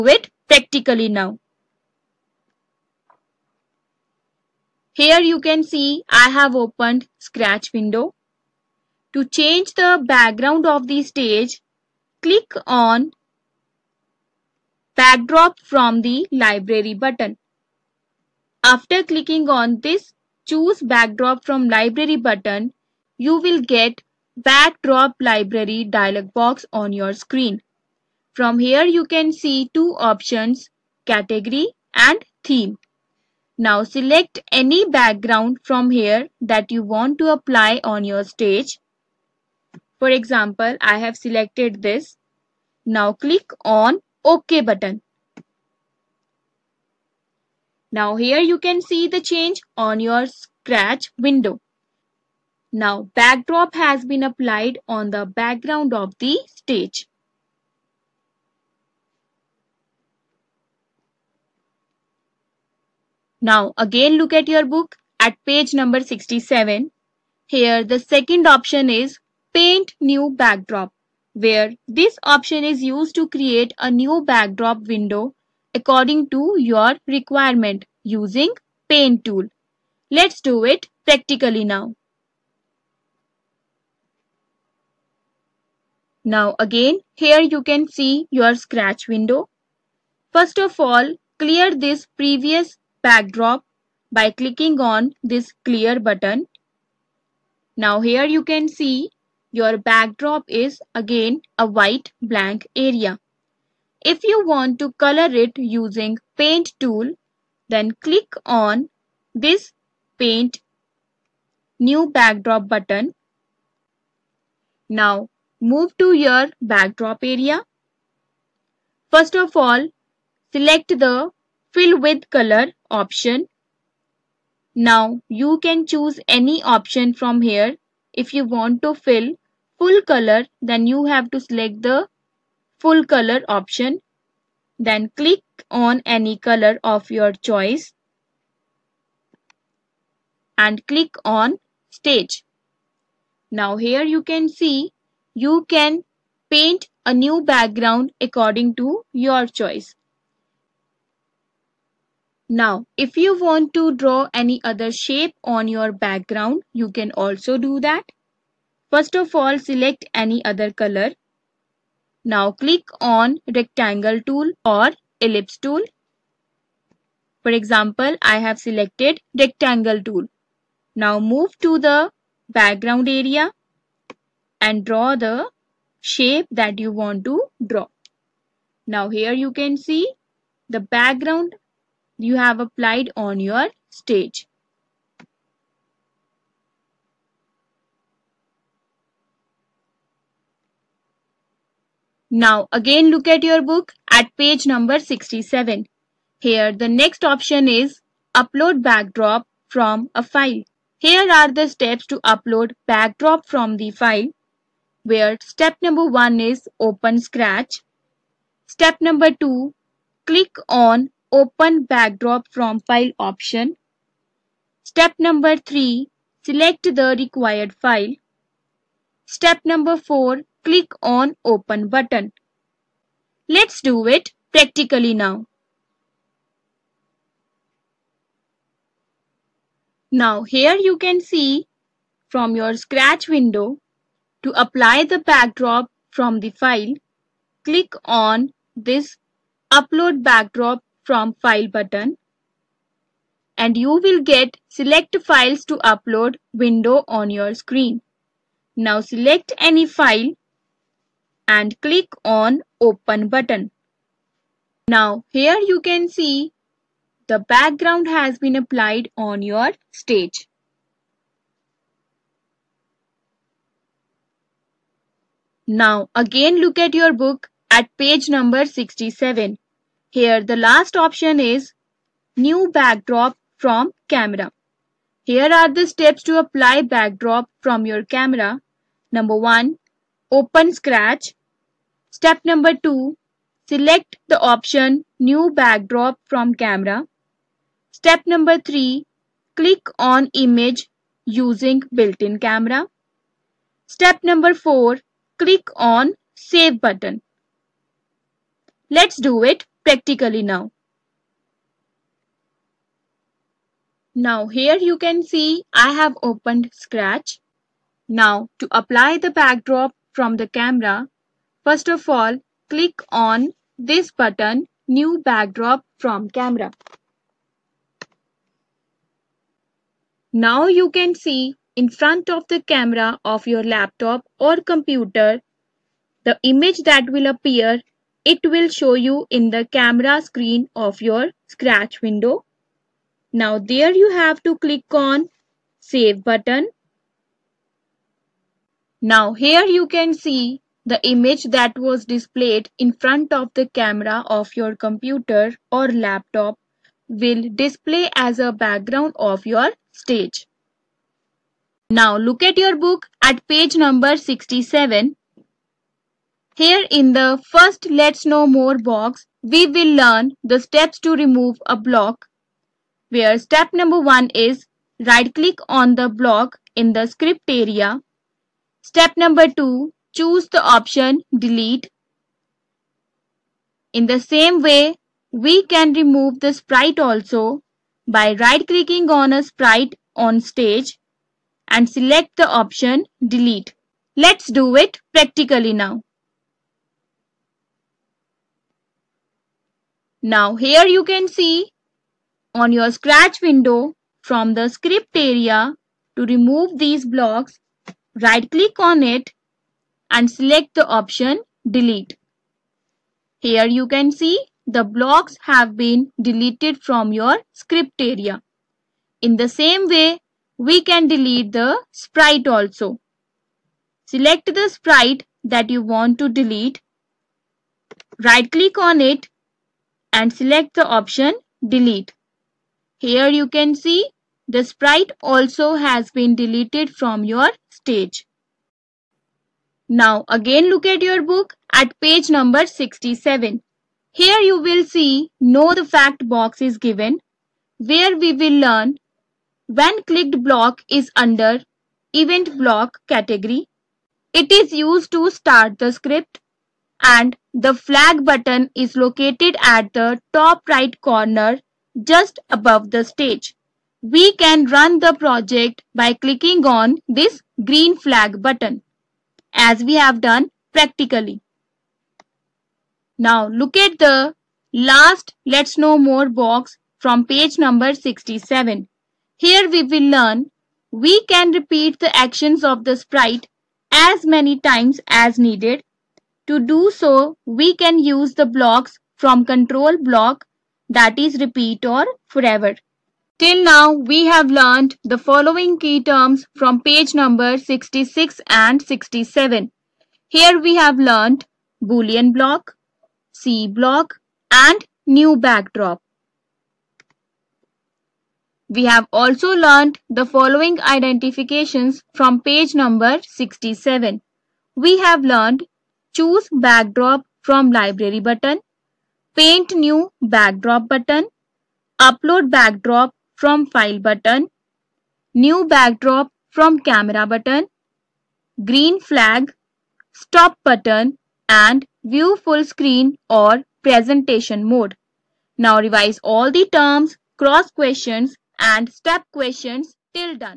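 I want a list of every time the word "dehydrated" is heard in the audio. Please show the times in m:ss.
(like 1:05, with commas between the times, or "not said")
not said.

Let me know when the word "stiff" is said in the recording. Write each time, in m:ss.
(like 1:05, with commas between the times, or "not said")
not said.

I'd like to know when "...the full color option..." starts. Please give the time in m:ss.
2:11.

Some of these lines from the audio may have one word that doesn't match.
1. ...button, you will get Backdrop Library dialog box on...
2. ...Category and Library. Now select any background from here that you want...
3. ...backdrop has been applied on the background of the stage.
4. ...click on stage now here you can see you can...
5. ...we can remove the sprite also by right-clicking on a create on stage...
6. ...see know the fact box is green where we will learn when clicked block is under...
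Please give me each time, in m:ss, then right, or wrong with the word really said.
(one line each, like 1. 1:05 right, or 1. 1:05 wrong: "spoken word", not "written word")
1. 0:22 right
2. 0:31 wrong: "Theme", not "Library"
3. 0:53 right
4. 2:20 right
5. 6:15 wrong: "sprite", not "create"
6. 7:14 wrong: "given", not "green".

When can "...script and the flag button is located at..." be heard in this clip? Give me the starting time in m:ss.
7:25.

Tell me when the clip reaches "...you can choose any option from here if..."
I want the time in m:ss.
2:05.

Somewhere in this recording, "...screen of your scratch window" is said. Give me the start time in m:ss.
5:30.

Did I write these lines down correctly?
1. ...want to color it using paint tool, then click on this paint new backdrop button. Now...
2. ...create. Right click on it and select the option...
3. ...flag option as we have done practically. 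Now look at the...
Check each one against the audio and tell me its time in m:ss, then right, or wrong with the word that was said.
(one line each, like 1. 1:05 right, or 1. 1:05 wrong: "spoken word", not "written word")
1. 1:44 right
2. 6:56 wrong: "delete", not "create"
3. 7:37 wrong: "button", not "option".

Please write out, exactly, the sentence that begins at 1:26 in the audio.
Now again, here you can see your scratch window.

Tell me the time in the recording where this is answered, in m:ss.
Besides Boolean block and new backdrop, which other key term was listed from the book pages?
8:13.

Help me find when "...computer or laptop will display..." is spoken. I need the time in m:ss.
5:44.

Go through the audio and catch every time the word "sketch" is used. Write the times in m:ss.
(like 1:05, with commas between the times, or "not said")
not said.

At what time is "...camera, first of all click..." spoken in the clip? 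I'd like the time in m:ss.
5:10.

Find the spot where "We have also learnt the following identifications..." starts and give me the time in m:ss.
8:18.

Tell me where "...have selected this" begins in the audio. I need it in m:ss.
0:40.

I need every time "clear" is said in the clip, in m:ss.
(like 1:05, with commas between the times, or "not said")
1:31, 1:35.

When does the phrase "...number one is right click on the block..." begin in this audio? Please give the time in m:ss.
6:03.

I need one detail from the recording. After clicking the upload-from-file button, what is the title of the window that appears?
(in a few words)
Select files to upload.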